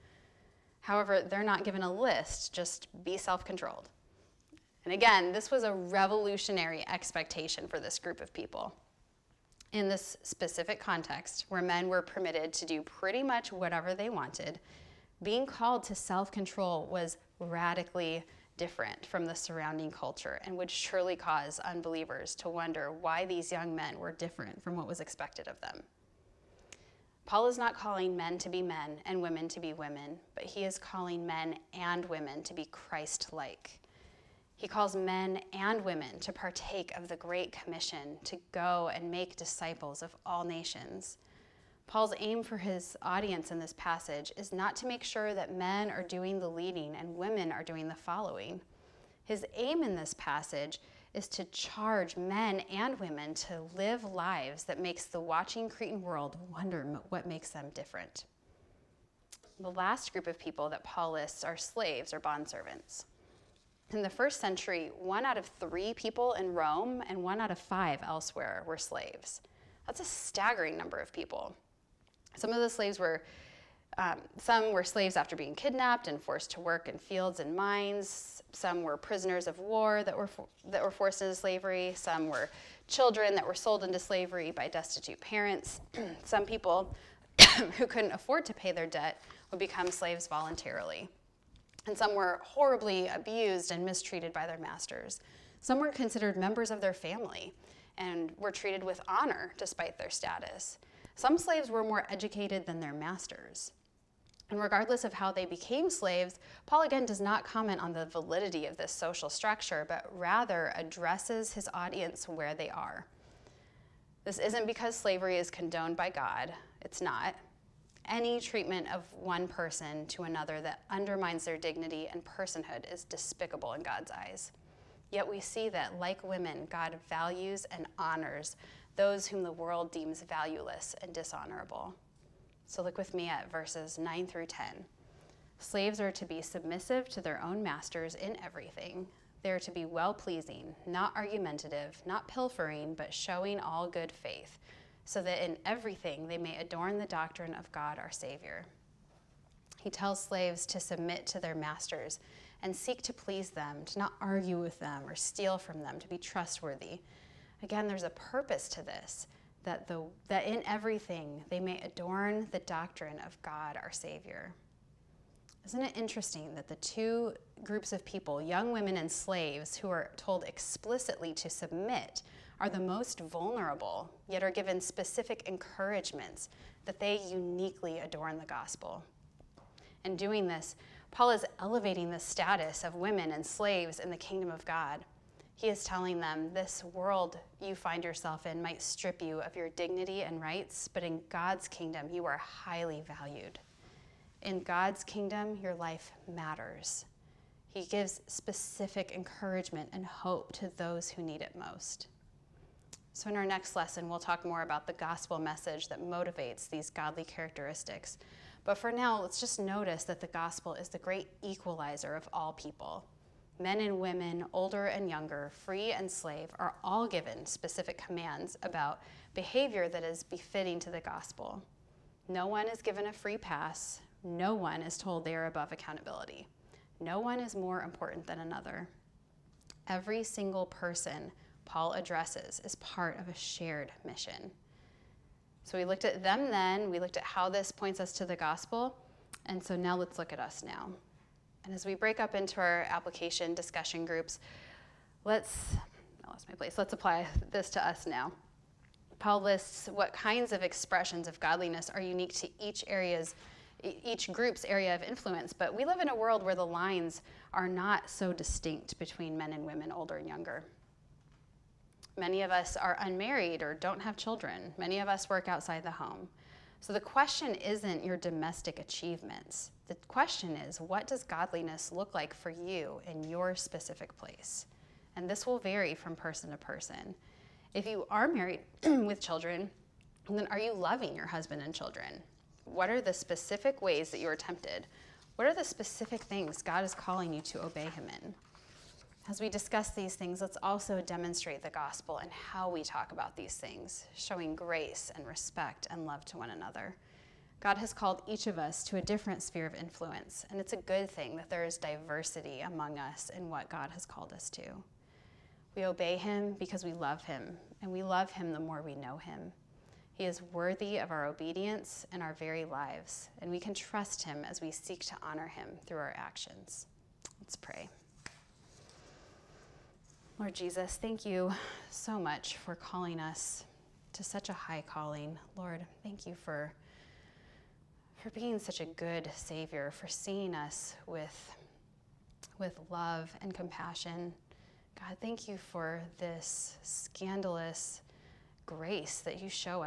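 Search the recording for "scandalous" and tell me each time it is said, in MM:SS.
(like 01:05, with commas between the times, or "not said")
05:36.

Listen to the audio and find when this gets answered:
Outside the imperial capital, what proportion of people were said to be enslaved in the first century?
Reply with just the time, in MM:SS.
01:07.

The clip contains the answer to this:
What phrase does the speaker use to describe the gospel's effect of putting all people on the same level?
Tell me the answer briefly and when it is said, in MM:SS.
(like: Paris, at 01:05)
the great equalizer, at 03:30.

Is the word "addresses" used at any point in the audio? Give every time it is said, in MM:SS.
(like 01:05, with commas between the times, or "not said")
01:50, 03:51.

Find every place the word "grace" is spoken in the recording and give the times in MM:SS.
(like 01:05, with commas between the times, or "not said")
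04:54, 05:38.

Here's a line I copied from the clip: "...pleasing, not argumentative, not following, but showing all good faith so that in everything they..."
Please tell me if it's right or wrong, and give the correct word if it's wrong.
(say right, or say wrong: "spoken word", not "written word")
wrong: "pilfering", not "following".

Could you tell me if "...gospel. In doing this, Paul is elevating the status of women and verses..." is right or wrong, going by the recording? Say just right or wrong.
wrong.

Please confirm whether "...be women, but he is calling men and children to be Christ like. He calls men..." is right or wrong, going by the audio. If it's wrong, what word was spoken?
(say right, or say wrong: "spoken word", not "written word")
wrong: "women", not "children".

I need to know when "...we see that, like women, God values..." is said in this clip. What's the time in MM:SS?
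02:05.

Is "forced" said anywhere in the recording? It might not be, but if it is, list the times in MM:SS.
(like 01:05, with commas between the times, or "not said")
01:16, 01:20.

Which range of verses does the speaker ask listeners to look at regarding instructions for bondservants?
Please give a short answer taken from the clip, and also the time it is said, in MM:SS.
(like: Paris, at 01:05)
9 through 10, at 02:13.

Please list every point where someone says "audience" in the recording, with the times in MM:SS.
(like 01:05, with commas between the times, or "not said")
00:43, 01:51.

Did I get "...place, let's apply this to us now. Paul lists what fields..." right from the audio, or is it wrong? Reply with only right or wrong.
wrong.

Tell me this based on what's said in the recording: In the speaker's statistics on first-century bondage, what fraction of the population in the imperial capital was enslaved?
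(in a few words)
1 out of 3.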